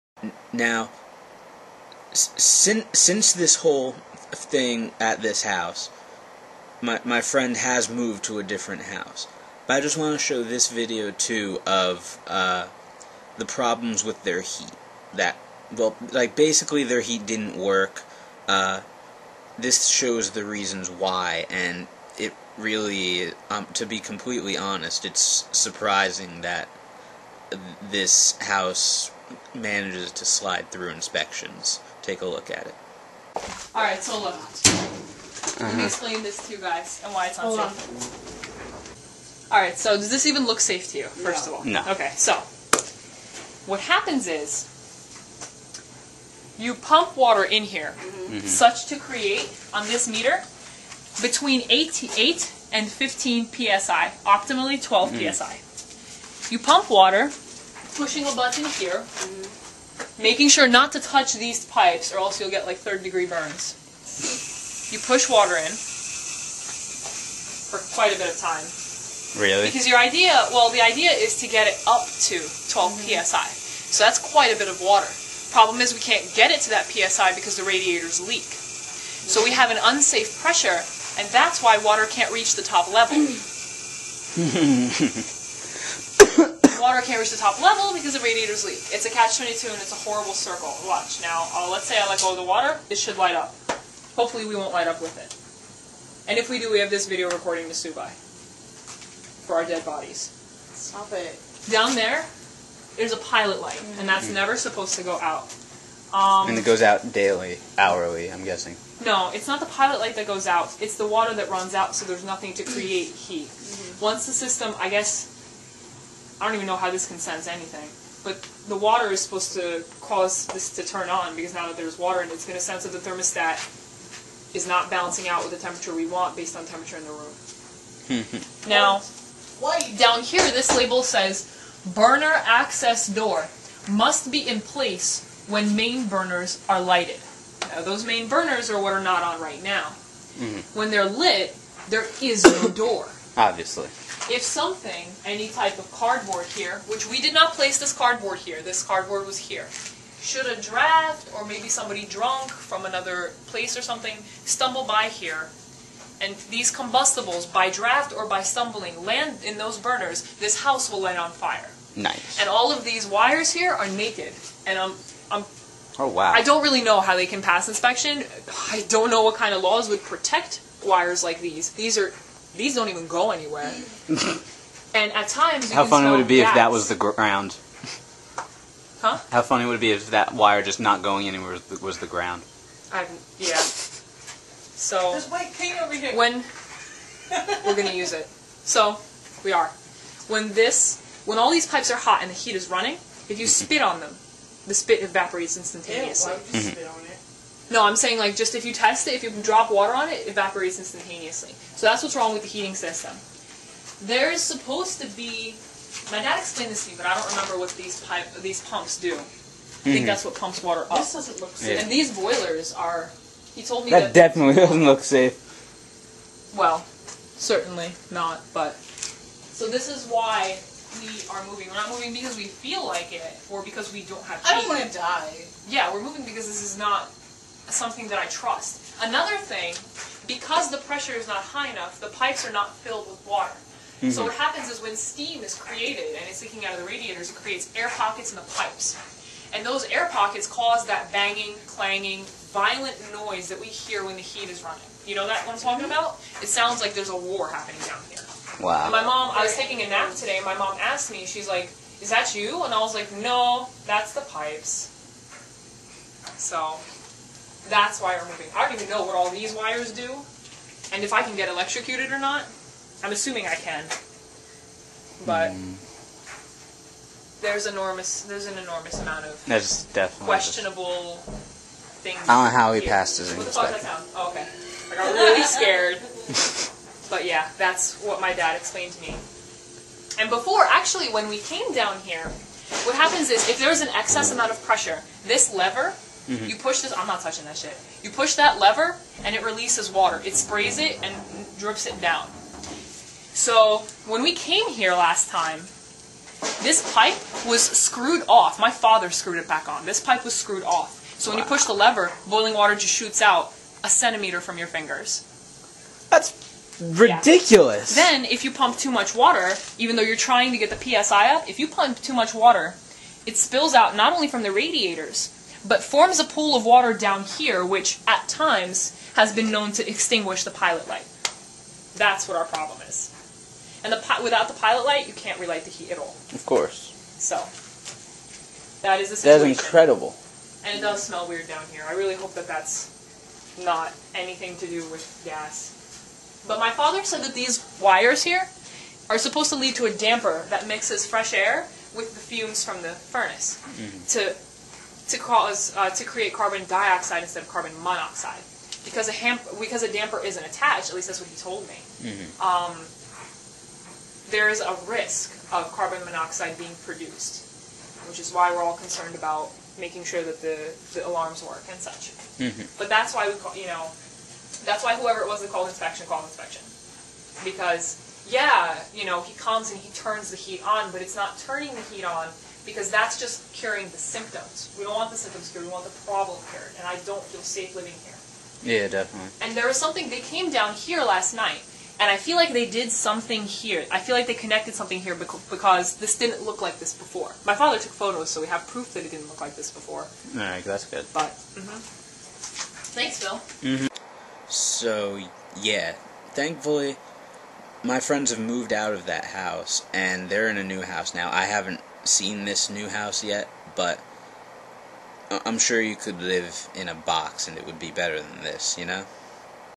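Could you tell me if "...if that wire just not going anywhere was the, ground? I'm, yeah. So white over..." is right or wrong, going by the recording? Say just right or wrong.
right.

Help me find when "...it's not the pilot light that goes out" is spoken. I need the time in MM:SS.
01:49.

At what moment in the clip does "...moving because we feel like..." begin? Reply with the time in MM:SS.
03:41.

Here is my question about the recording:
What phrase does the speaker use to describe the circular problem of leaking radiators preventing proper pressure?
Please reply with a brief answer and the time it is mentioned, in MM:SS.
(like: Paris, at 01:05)
catch-22, at 01:29.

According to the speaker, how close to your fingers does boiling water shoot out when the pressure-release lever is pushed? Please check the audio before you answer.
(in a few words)
a centimeter.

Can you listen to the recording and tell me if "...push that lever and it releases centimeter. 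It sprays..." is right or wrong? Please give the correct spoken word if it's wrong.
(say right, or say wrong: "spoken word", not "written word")
wrong: "water", not "centimeter".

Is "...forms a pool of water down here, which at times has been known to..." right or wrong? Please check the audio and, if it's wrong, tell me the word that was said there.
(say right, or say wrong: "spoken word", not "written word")
right.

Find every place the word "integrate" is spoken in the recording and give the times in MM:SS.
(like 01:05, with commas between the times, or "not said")
not said.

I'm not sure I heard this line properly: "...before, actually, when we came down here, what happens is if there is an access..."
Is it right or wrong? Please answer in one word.
wrong.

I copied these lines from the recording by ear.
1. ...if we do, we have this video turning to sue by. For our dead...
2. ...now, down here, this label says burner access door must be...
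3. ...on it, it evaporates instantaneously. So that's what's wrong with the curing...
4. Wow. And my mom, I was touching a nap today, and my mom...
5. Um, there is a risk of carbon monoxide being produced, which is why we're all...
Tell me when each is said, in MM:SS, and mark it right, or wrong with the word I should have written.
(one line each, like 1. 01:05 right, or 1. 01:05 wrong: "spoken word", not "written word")
1. 01:36 wrong: "recording", not "turning"
2. 02:08 right
3. 03:19 wrong: "heating", not "curing"
4. 04:08 wrong: "taking", not "touching"
5. 05:52 right.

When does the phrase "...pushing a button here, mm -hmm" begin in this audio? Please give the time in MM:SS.
00:57.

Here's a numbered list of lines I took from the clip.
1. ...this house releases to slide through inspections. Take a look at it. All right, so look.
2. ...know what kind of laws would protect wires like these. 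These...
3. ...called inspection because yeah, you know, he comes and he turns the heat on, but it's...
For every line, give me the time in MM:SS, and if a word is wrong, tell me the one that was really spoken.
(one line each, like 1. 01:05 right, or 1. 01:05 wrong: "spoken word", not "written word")
1. 00:27 wrong: "manages", not "releases"
2. 02:49 right
3. 06:06 right.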